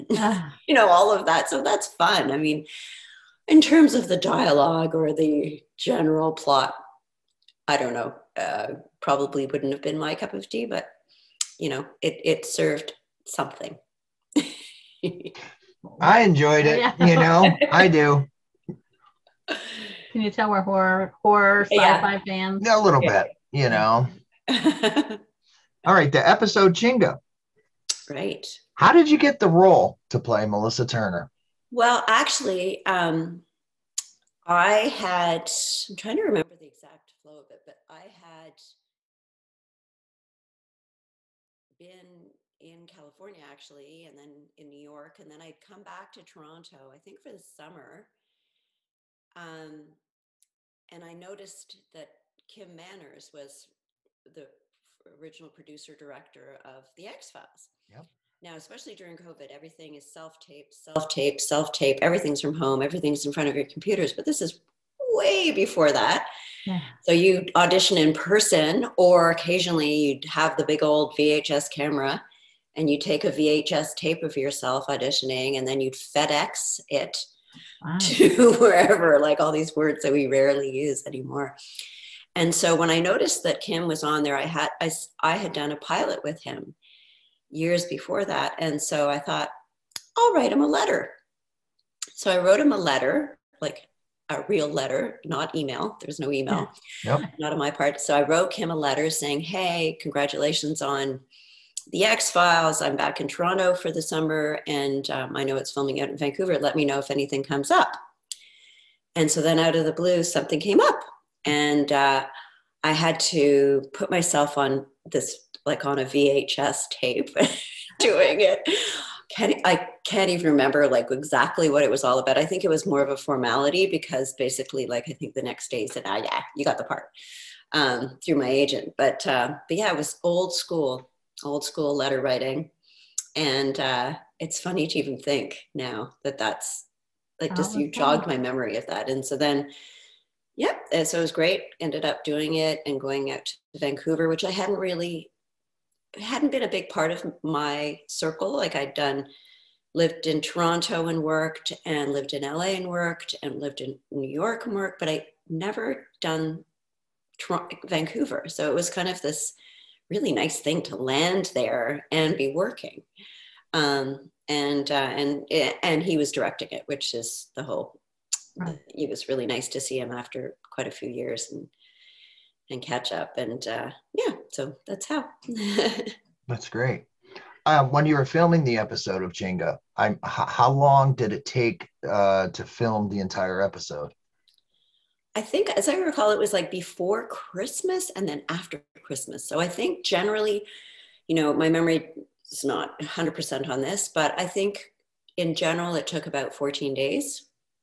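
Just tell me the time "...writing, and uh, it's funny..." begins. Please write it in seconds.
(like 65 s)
132 s.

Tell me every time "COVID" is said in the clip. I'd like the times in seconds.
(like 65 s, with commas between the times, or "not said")
59 s.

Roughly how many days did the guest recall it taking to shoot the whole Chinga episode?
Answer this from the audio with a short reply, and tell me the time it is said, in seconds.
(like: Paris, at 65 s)
14, at 196 s.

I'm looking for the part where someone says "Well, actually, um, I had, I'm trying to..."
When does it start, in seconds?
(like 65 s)
31 s.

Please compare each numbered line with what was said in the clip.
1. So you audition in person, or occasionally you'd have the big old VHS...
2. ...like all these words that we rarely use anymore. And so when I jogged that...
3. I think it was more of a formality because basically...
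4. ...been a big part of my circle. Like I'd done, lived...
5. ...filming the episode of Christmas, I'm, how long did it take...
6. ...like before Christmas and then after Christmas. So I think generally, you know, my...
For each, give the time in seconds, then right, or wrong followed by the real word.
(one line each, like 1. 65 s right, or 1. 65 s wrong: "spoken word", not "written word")
1. 67 s right
2. 79 s wrong: "noticed", not "jogged"
3. 122 s right
4. 146 s right
5. 178 s wrong: "Chinga", not "Christmas"
6. 186 s right.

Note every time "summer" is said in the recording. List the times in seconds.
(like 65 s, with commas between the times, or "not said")
47 s, 104 s.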